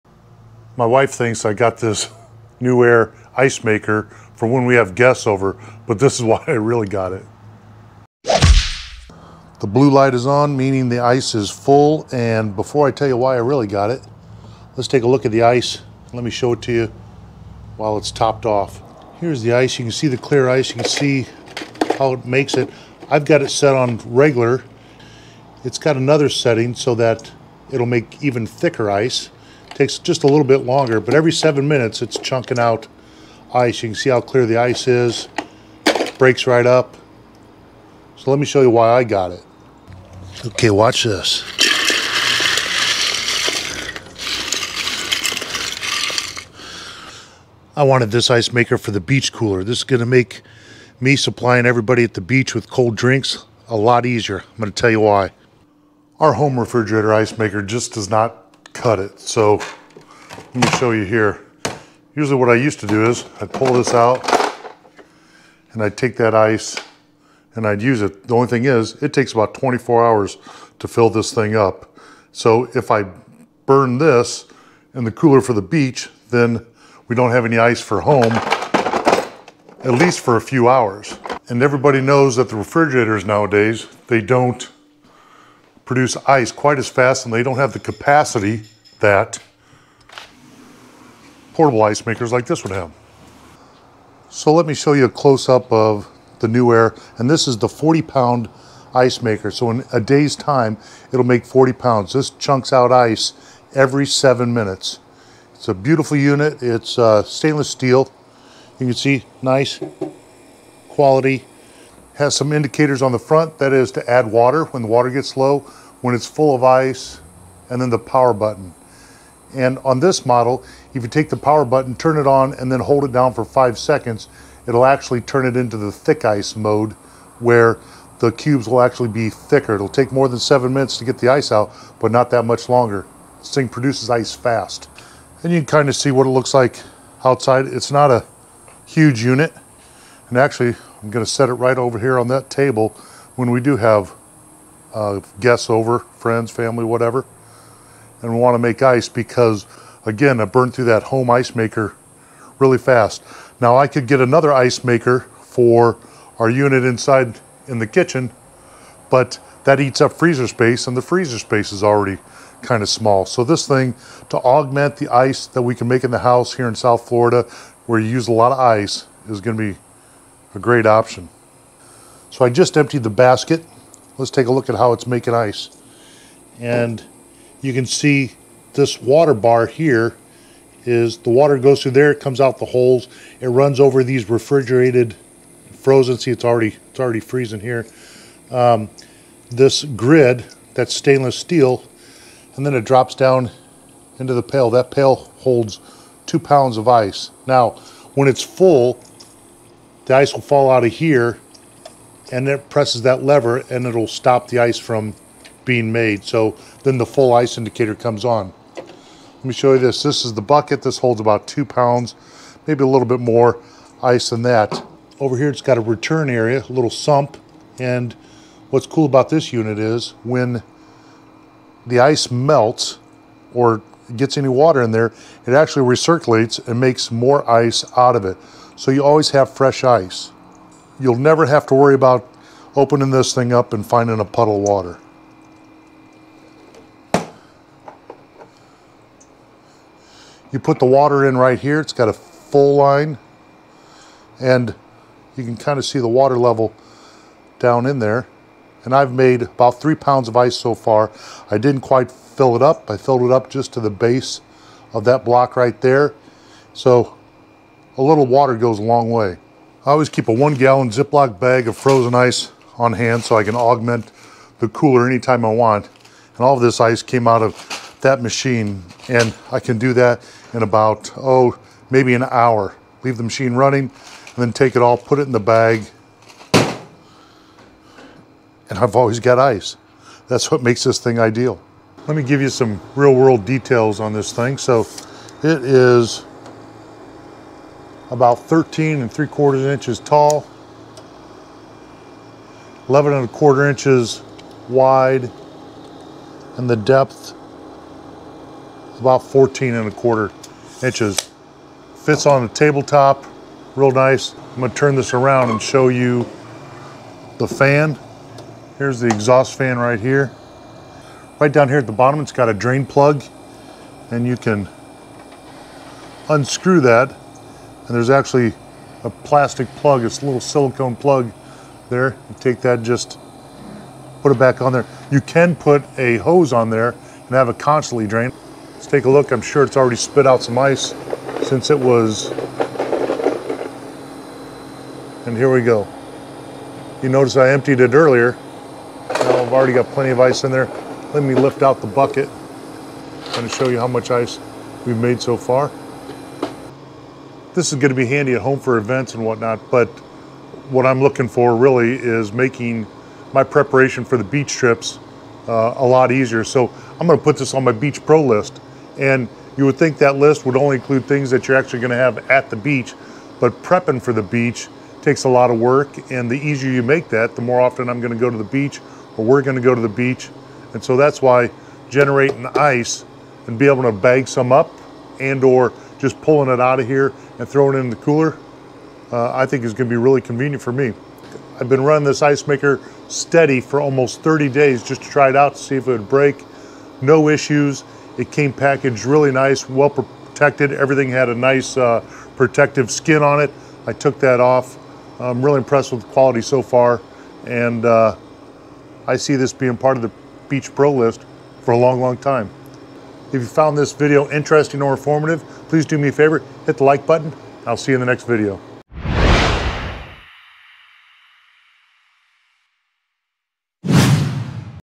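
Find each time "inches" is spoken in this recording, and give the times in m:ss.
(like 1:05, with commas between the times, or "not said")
4:49, 4:53, 5:00.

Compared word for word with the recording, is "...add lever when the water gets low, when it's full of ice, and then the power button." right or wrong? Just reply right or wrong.
wrong.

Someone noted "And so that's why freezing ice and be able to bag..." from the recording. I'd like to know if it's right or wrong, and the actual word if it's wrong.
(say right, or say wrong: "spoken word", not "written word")
wrong: "generating", not "freezing".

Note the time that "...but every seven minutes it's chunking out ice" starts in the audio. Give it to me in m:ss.
0:30.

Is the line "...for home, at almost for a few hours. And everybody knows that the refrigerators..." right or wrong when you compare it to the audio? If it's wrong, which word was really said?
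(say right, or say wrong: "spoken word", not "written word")
wrong: "least", not "almost".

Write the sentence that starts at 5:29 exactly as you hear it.
I'm sure it's already spit out some ice since it was.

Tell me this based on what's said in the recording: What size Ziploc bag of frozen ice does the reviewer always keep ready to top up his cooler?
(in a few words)
1 gallon.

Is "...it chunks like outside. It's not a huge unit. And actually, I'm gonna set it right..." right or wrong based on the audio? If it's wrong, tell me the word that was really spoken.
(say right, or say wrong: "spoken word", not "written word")
wrong: "looks", not "chunks".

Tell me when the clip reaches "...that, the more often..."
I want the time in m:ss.
6:07.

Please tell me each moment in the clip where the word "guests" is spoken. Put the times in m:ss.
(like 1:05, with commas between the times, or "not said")
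0:04, 2:25.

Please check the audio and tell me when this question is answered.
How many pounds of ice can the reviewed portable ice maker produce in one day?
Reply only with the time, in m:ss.
1:41.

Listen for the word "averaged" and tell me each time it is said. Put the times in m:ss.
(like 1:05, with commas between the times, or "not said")
not said.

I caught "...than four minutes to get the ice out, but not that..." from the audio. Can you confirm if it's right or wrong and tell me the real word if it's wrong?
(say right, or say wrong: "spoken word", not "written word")
wrong: "seven", not "four".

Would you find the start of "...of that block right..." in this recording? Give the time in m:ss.
4:14.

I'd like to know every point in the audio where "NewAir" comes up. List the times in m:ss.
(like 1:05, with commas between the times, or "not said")
0:02, 1:36.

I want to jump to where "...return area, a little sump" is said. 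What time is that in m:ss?
3:35.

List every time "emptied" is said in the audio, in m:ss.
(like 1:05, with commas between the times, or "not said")
2:52, 5:37.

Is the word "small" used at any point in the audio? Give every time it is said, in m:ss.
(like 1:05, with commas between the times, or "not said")
2:42.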